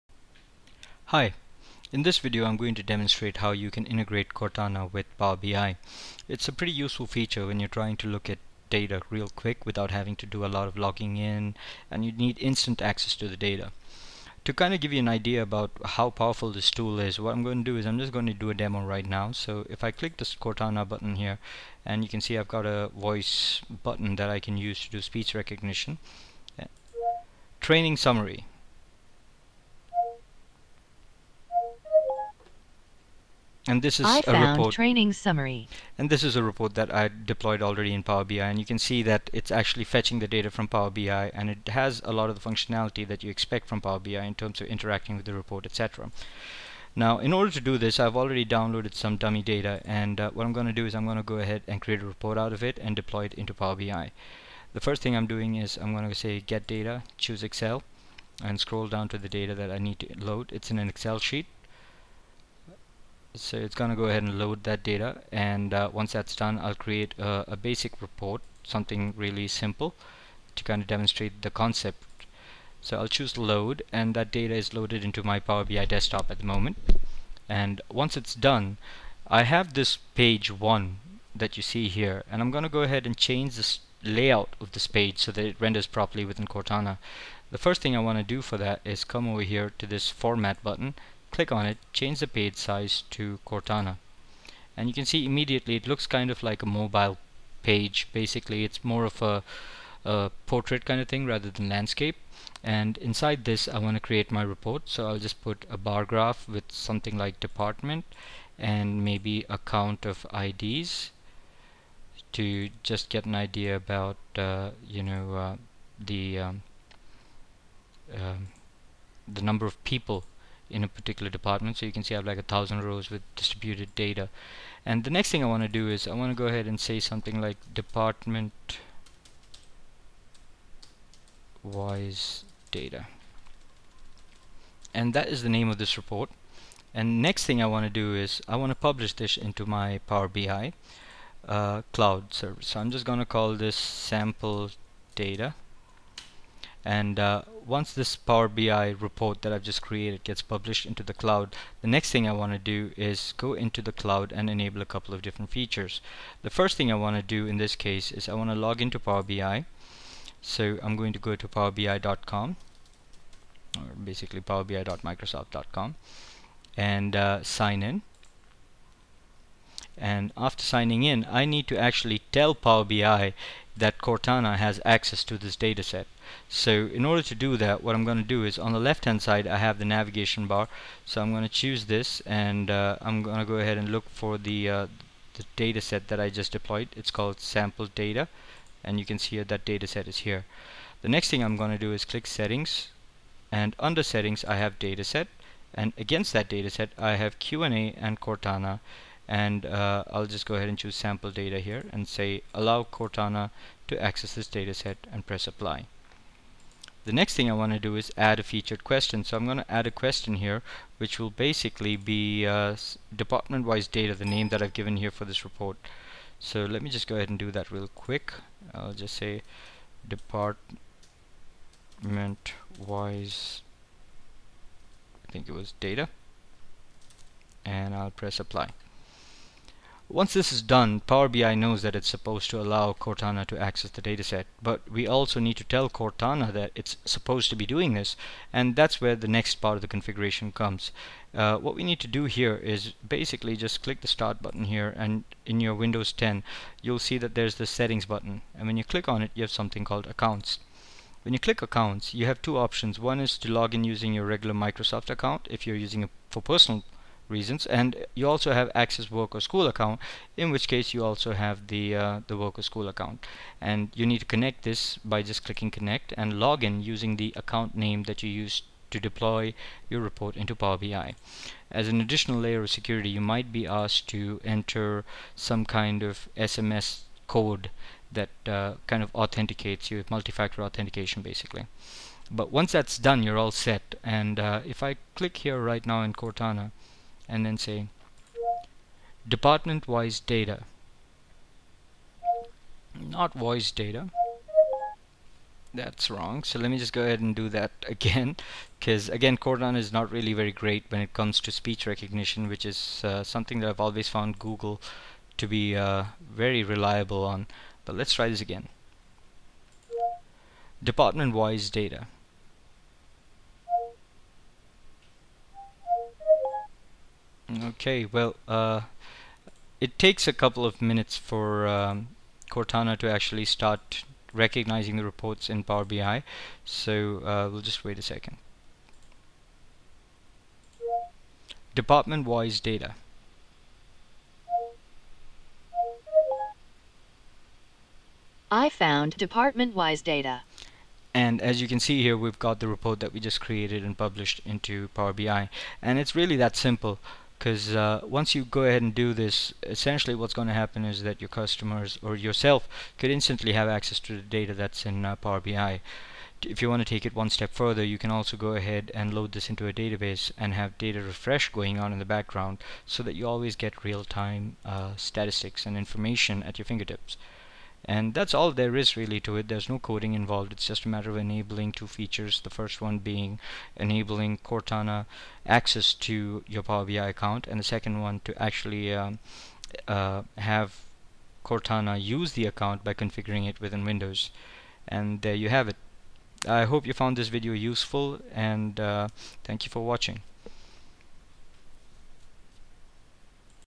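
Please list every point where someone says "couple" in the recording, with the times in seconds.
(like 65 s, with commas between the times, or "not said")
154 s, 320 s.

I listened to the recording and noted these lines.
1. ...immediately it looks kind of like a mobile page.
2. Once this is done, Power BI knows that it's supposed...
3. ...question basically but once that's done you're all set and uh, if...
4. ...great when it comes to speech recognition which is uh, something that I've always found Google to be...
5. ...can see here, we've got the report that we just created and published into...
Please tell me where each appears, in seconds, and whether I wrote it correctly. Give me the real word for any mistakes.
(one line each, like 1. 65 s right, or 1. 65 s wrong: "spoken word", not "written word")
1. 95 s right
2. 230 s right
3. 280 s wrong: "authentication", not "question"
4. 300 s right
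5. 341 s right.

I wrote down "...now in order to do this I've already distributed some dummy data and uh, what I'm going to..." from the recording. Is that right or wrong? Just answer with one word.
wrong.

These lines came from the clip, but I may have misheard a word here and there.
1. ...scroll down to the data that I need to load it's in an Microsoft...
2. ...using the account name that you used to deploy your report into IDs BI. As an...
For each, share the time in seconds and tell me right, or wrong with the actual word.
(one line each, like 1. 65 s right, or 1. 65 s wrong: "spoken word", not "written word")
1. 58 s wrong: "Excel", not "Microsoft"
2. 266 s wrong: "Power", not "IDs".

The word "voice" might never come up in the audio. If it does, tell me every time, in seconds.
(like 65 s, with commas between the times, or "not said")
22 s, 293 s.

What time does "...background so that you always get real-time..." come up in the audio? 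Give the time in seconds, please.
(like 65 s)
362 s.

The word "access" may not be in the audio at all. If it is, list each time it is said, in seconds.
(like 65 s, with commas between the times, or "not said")
12 s, 174 s, 204 s, 233 s, 258 s, 353 s, 375 s.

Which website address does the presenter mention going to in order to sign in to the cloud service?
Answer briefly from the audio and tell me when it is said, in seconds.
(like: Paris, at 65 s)
powerbi.microsoft.com, at 164 s.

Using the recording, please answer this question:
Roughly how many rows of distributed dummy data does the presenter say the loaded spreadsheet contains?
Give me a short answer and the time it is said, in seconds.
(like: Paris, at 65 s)
1000, at 122 s.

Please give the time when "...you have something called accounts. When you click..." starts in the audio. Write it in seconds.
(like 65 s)
249 s.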